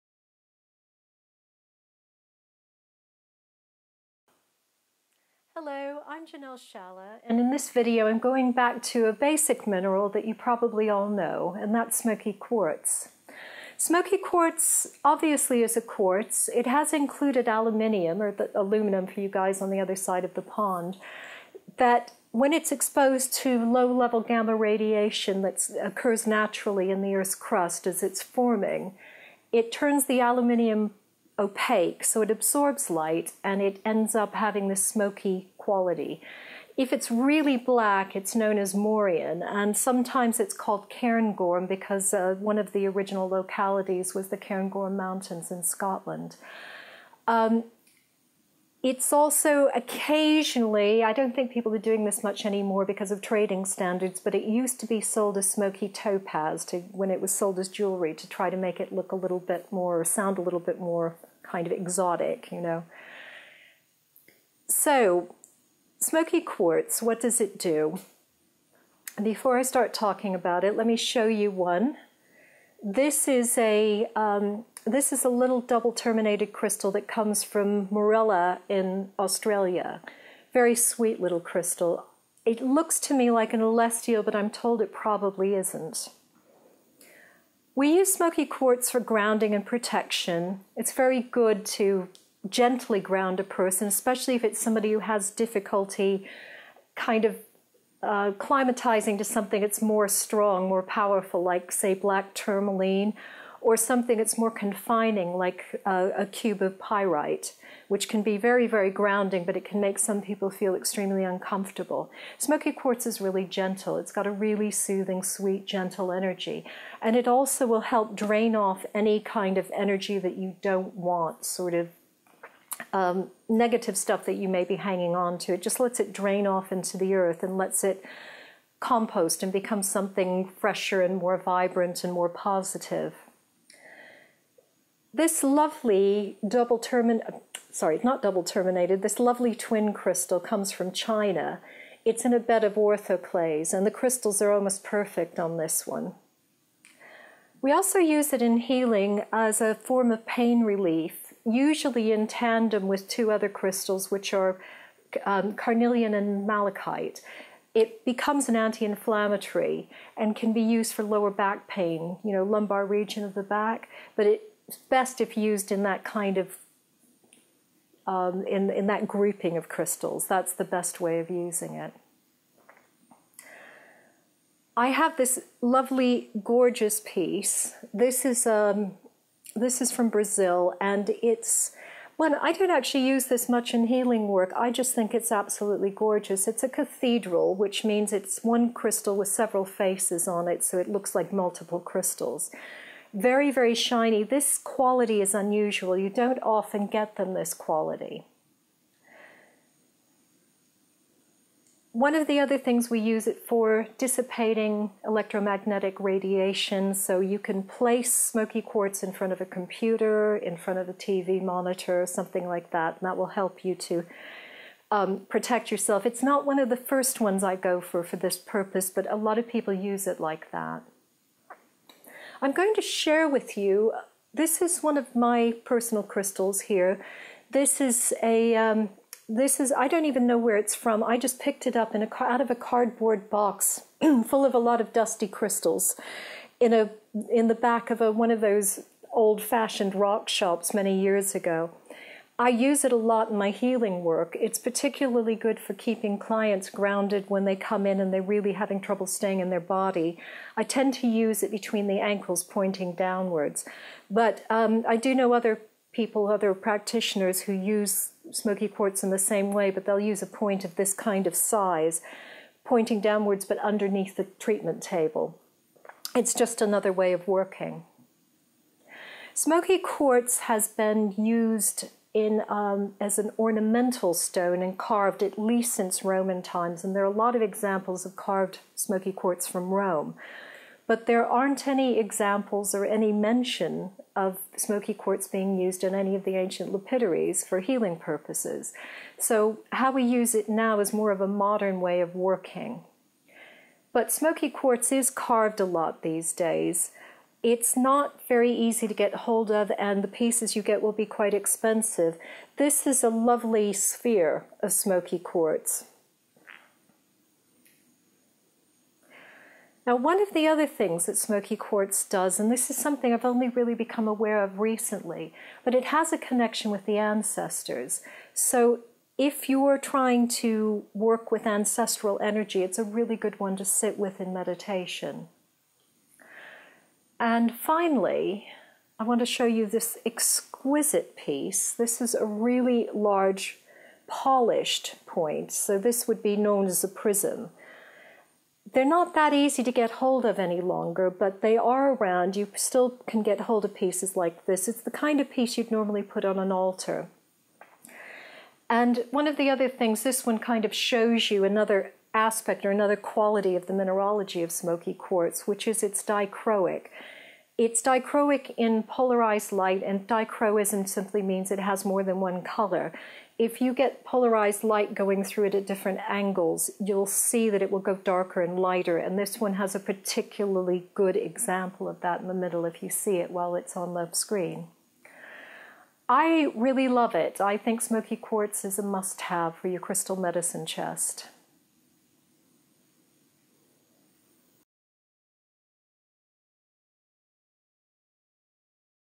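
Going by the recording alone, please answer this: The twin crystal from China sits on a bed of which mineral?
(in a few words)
orthoclase.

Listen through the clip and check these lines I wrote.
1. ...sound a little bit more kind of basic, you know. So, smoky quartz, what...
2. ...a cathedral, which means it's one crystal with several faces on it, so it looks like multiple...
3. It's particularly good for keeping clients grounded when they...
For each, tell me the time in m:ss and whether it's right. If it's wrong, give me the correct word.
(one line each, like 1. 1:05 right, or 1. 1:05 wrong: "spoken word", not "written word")
1. 1:00 wrong: "exotic", not "basic"
2. 3:06 right
3. 4:04 right.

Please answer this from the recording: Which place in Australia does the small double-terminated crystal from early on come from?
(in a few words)
Morella.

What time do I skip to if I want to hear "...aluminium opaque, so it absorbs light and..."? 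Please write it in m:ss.
0:30.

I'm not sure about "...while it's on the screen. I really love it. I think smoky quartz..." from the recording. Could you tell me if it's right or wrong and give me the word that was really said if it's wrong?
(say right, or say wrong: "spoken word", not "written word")
right.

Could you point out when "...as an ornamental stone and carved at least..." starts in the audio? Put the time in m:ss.
4:32.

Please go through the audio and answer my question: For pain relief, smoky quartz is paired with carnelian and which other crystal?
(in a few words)
malachite.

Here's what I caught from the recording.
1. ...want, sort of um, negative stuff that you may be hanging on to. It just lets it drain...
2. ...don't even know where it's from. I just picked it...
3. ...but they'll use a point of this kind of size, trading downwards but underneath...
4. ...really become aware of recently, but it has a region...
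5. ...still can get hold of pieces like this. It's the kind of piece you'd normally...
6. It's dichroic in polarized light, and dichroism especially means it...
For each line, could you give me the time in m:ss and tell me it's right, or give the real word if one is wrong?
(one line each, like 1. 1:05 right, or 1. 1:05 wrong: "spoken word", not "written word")
1. 2:00 right
2. 3:49 right
3. 4:19 wrong: "pointing", not "trading"
4. 5:13 wrong: "connection", not "region"
5. 5:42 right
6. 5:57 wrong: "simply", not "especially".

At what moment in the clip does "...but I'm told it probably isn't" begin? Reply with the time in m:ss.
1:24.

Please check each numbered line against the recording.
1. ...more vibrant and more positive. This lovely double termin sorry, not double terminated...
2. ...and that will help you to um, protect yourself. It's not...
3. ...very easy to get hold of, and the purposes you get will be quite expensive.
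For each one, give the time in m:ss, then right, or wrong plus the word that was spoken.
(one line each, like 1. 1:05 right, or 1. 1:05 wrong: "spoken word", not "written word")
1. 2:11 right
2. 3:32 right
3. 4:58 wrong: "pieces", not "purposes".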